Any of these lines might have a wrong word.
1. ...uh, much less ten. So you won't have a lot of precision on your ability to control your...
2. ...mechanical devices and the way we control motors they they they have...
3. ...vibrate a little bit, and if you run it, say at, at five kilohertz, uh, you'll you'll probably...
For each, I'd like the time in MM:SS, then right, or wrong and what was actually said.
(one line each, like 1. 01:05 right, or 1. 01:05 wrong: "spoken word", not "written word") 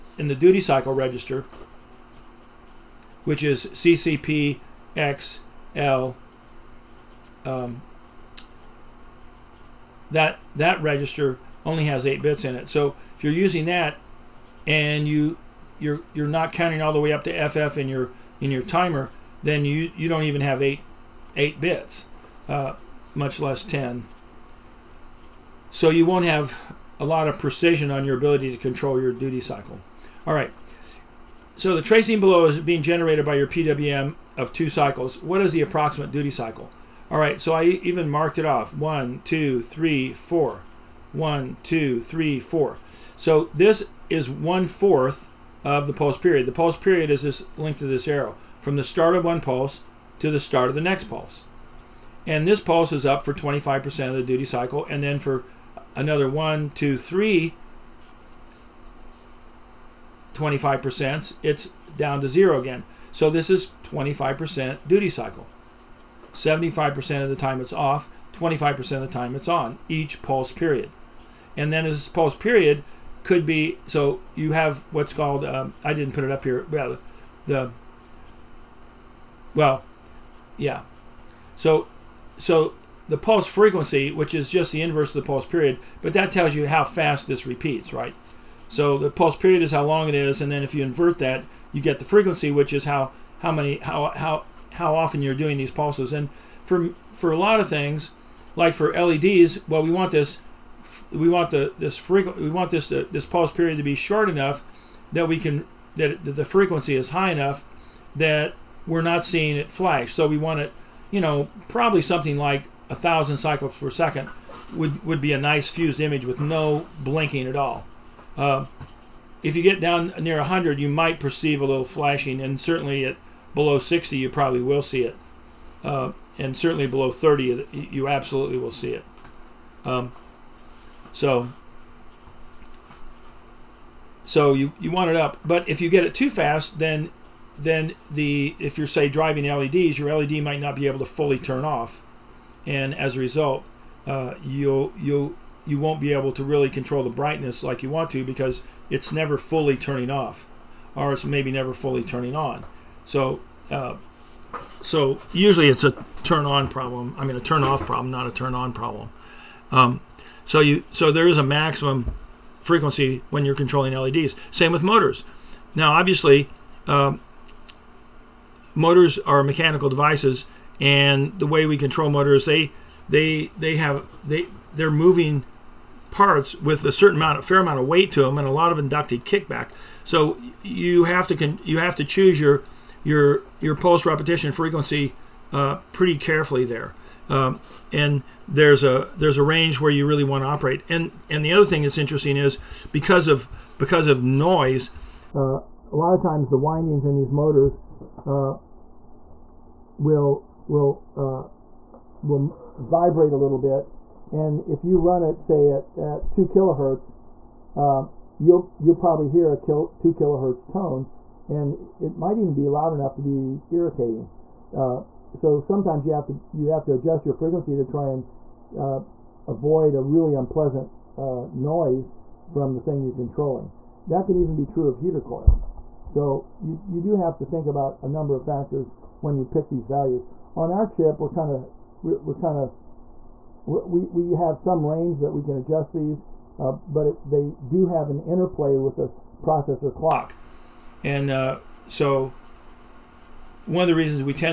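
1. 00:22 right
2. 02:49 right
3. 03:22 wrong: "two", not "five".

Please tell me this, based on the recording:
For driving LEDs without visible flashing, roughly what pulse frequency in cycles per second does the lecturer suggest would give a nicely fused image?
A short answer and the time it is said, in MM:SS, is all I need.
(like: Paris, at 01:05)
1000, at 01:52.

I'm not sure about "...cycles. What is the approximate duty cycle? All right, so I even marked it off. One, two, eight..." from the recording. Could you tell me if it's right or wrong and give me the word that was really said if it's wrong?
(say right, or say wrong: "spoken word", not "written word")
wrong: "three", not "eight".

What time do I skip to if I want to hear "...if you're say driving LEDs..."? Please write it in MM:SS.
02:18.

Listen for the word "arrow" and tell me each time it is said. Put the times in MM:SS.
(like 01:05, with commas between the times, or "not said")
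00:48.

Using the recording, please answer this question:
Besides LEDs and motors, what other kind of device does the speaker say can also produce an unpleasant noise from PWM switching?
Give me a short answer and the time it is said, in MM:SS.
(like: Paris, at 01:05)
heater coils, at 03:44.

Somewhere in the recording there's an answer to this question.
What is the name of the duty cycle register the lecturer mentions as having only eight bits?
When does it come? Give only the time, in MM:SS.
00:03.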